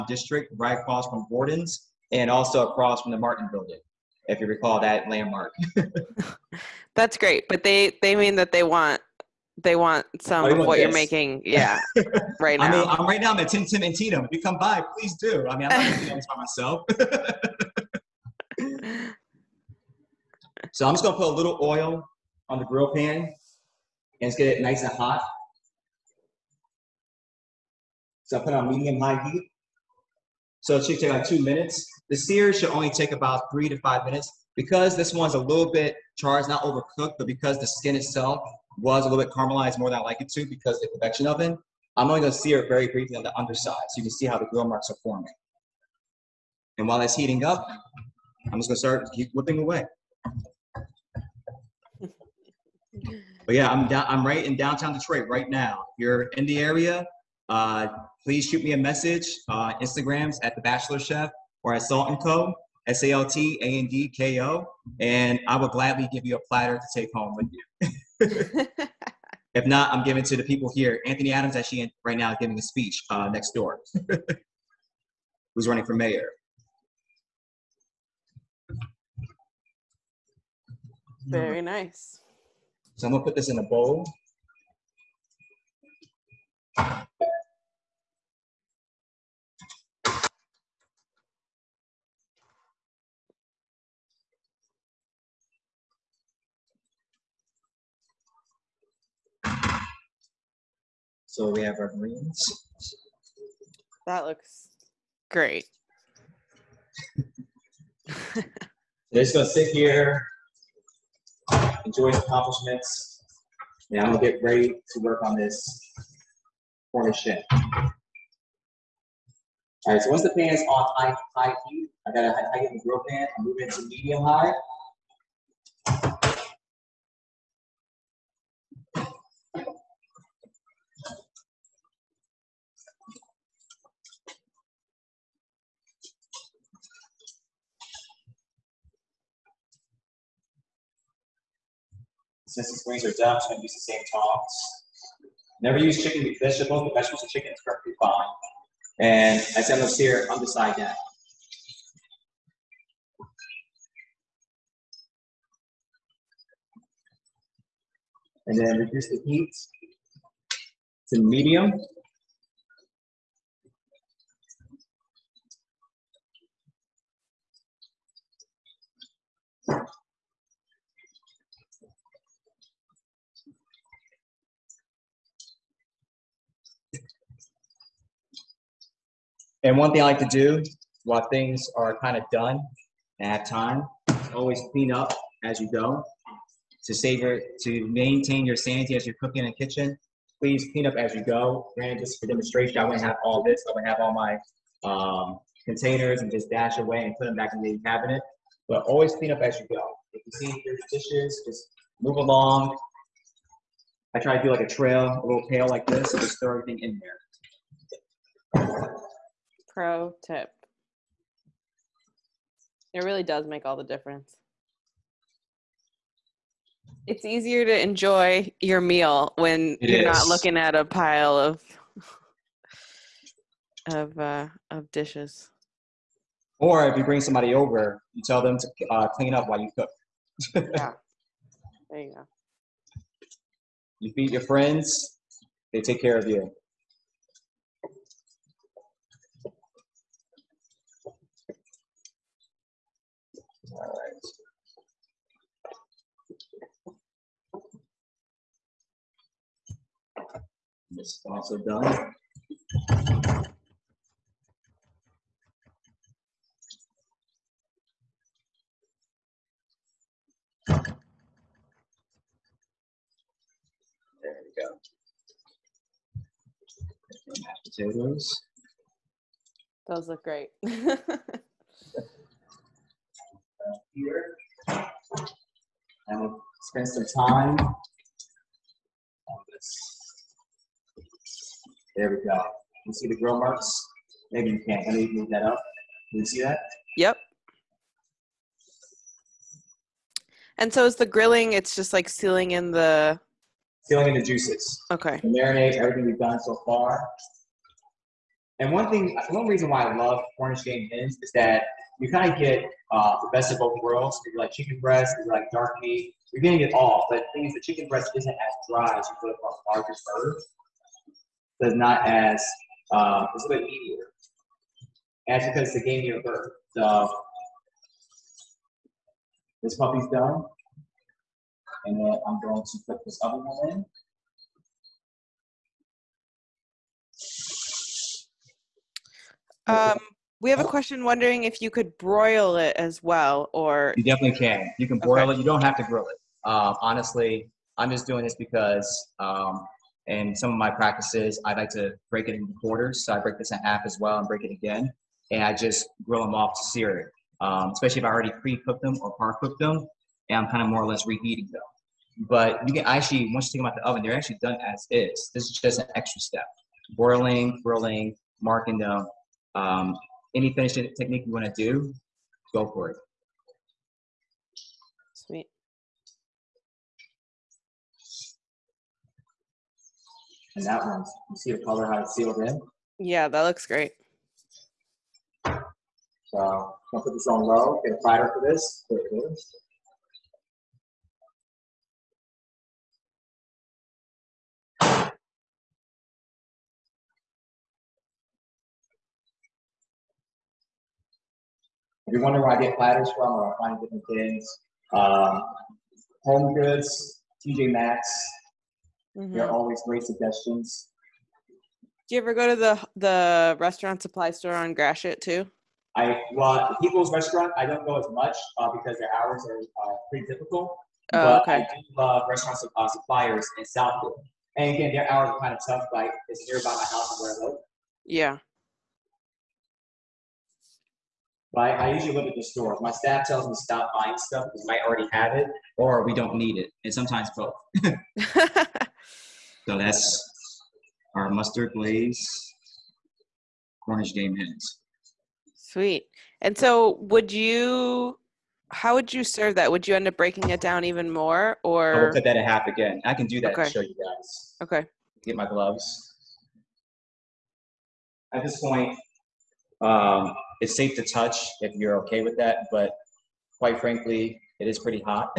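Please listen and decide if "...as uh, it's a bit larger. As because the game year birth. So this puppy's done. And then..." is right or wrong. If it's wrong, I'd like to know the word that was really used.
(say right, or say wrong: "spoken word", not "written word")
wrong: "easier", not "larger".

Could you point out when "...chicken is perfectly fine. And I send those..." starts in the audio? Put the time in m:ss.
2:27.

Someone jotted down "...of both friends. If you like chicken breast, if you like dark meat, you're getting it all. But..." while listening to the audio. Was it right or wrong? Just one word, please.
wrong.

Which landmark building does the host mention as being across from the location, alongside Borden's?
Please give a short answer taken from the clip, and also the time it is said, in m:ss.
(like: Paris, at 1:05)
Martin Building, at 0:03.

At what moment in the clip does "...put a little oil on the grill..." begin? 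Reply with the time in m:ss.
0:21.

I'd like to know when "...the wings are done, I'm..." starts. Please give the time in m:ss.
2:22.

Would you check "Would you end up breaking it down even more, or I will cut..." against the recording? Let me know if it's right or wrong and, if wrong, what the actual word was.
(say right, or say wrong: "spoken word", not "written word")
right.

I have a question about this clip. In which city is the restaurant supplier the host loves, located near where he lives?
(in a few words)
Southfield.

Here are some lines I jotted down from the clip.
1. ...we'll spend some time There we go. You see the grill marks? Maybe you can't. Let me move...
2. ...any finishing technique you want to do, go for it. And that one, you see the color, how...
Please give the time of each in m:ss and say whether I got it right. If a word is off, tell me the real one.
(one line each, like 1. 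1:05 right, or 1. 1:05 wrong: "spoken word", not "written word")
1. 4:36 right
2. 6:00 right.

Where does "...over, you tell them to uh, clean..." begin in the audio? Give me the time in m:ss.
3:47.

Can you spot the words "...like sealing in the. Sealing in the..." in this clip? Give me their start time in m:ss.
4:51.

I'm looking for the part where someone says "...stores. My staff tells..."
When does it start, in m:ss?
7:02.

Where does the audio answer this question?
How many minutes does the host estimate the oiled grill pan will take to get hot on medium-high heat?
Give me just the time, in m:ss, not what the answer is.
0:31.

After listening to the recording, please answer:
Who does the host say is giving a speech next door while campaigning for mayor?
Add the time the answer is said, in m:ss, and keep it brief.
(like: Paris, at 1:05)
Anthony Adams, at 1:11.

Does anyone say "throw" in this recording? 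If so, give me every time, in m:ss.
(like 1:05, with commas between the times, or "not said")
3:26.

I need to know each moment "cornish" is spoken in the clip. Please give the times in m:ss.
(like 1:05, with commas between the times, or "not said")
1:56, 5:00, 7:13.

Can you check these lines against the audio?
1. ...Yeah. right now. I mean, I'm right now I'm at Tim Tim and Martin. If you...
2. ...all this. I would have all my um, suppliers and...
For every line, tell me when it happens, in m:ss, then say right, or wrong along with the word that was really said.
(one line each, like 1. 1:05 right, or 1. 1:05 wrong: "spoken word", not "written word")
1. 0:11 wrong: "Tino", not "Martin"
2. 3:13 wrong: "containers", not "suppliers".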